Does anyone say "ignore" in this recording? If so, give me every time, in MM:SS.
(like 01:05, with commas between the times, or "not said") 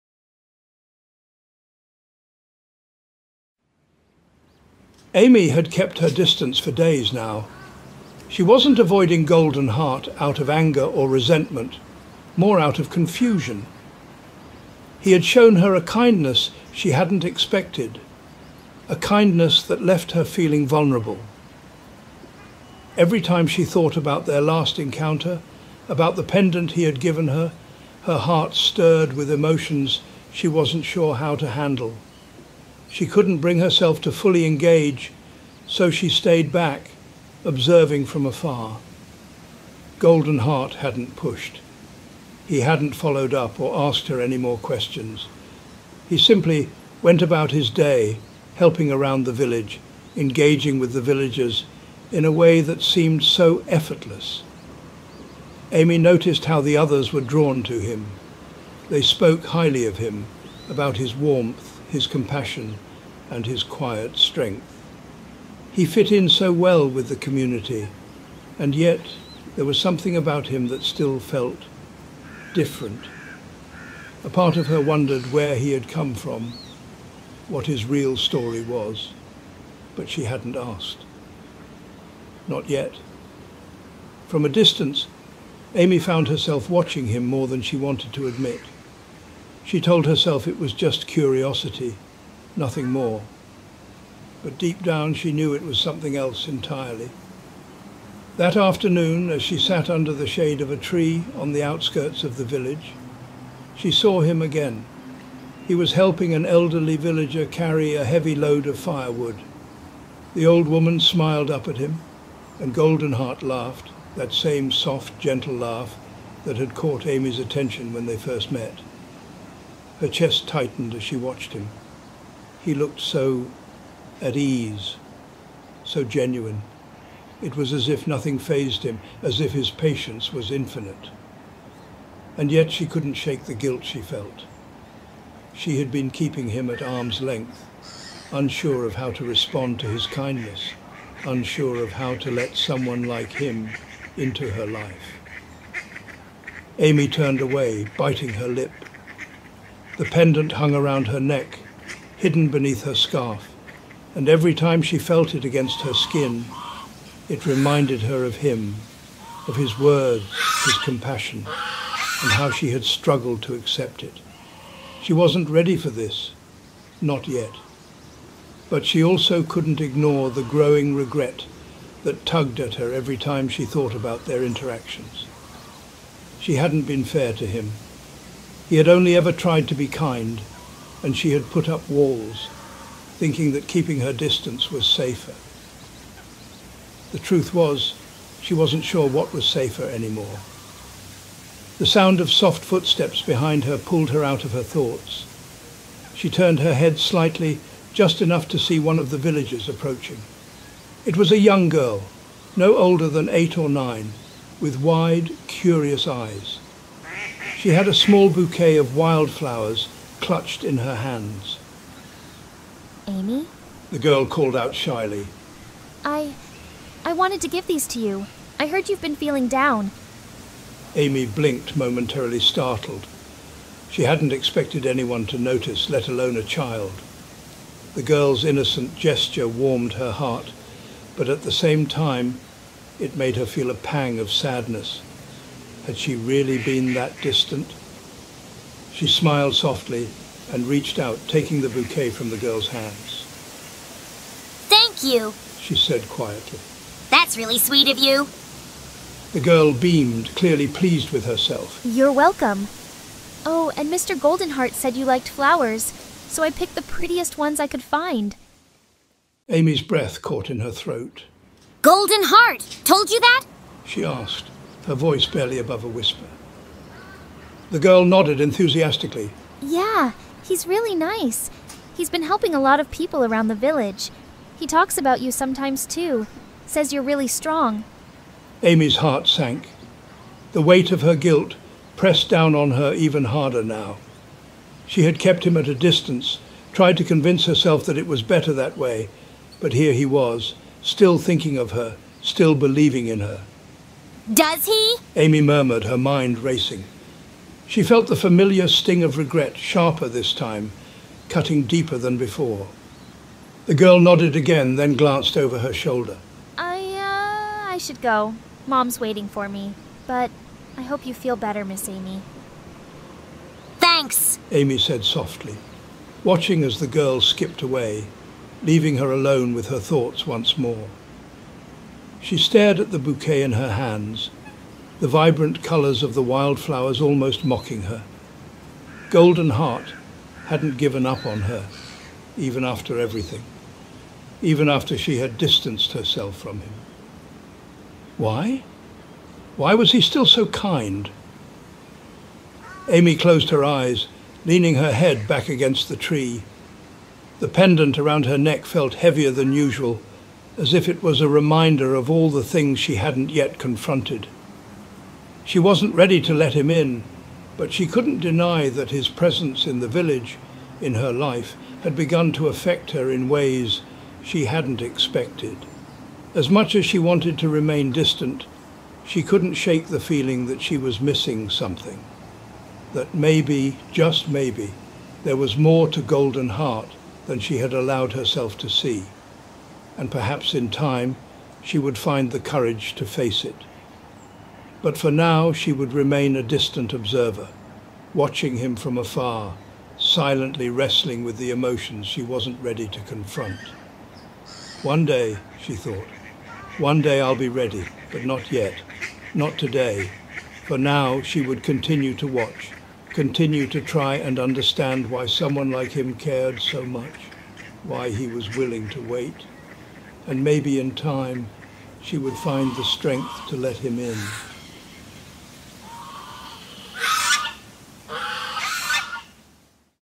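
02:49.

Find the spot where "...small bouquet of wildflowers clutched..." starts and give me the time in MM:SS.
03:27.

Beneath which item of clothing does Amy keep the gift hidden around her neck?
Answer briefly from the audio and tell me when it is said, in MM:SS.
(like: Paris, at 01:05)
Scarf, at 02:32.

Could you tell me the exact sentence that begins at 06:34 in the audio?
One day, she thought, one day I'll be ready, but not yet, not today.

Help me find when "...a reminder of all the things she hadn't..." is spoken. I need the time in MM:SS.
05:51.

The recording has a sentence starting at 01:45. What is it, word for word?
He was helping an elderly villager carry a heavy load of firewood.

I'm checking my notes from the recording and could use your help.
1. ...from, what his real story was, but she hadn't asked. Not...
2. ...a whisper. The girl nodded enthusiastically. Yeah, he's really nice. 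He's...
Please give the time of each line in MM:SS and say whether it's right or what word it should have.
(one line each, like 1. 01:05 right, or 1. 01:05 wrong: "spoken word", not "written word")
1. 01:16 right
2. 04:25 right.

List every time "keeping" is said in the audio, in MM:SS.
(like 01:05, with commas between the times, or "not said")
02:16, 03:03.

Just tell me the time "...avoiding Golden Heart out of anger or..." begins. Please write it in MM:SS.
00:08.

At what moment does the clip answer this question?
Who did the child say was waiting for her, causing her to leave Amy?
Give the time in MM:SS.
05:08.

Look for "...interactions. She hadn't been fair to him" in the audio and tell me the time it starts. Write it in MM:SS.
02:54.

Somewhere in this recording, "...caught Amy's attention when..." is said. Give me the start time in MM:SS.
01:56.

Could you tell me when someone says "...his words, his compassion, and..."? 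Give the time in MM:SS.
02:39.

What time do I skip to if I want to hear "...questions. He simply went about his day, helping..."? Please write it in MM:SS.
00:44.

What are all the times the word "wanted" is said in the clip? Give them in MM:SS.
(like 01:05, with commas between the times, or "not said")
01:27, 03:37, 06:06.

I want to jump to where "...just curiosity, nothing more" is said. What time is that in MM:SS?
01:30.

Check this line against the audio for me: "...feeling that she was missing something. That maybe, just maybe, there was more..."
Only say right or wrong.
right.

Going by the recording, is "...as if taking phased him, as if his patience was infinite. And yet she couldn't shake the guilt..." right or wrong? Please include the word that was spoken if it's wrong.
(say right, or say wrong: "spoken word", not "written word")
wrong: "nothing", not "taking".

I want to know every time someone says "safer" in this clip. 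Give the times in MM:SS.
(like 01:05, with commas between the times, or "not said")
03:04, 03:09.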